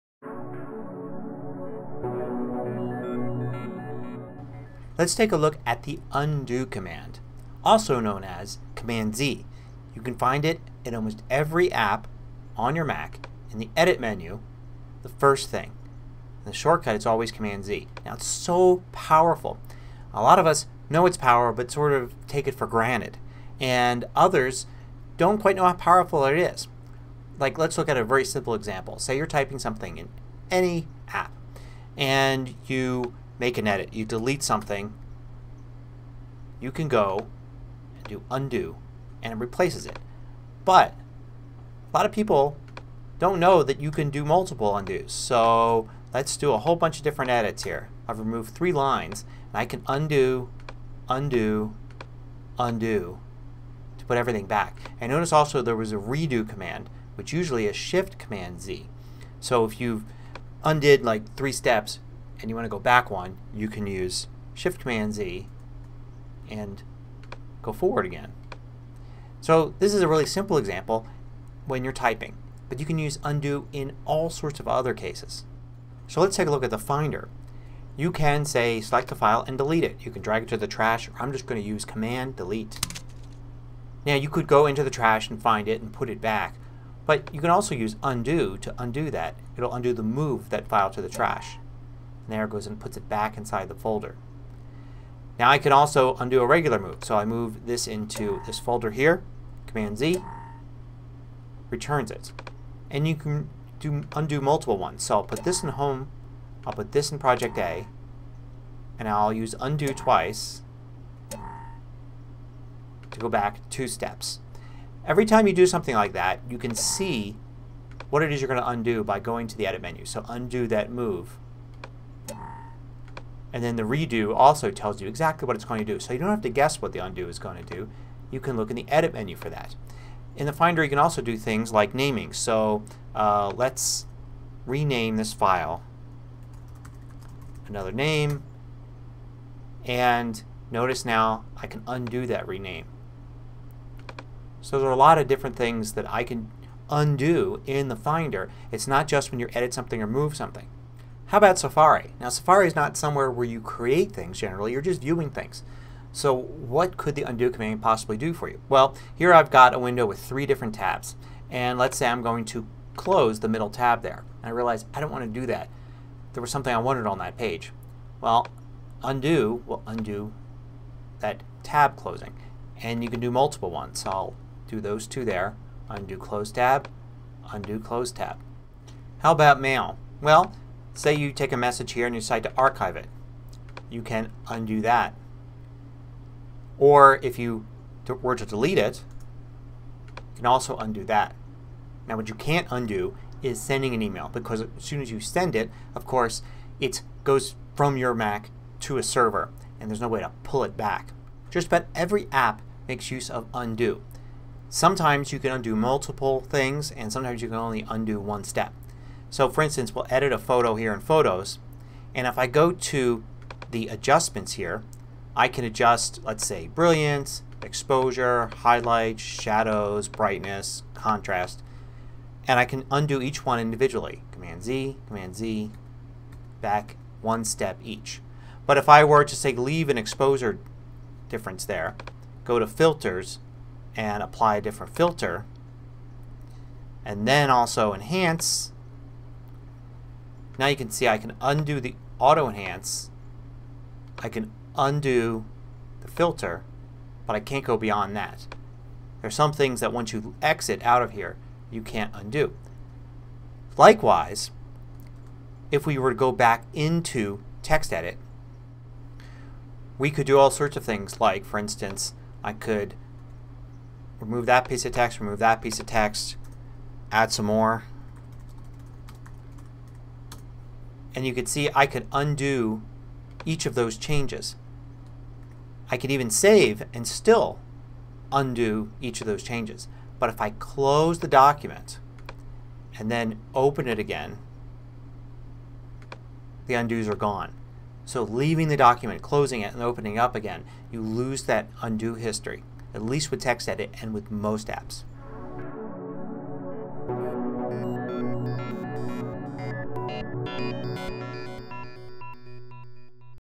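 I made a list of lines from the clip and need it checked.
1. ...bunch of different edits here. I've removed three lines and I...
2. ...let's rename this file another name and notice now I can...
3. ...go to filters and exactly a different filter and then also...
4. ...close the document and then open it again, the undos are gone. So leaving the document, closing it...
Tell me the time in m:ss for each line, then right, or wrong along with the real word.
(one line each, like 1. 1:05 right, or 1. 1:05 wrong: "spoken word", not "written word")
1. 0:46 right
2. 2:13 right
3. 3:52 wrong: "apply", not "exactly"
4. 4:40 right.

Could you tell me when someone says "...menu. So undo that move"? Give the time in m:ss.
1:59.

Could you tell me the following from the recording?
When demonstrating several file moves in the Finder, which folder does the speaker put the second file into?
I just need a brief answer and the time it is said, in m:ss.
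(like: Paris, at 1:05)
project A, at 1:47.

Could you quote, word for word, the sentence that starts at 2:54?
So I'll do those two there, undo close tab, undo close tab.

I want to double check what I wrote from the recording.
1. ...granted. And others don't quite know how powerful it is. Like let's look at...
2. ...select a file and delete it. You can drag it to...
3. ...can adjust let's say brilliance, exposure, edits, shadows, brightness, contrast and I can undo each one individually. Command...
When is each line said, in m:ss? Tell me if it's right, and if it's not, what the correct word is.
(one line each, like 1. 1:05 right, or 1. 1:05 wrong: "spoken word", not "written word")
1. 0:22 right
2. 1:18 right
3. 3:35 wrong: "highlights", not "edits".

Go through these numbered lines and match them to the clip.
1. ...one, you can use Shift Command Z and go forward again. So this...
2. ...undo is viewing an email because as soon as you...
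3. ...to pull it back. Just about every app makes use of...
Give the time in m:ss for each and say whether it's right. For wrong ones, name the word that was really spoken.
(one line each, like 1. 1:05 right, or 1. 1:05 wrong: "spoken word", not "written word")
1. 1:03 right
2. 3:12 wrong: "sending", not "viewing"
3. 3:20 right.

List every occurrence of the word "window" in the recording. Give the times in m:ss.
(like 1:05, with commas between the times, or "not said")
2:39.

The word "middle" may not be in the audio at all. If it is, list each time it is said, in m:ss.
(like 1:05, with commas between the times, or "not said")
2:43.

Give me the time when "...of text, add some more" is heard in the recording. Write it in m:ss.
4:25.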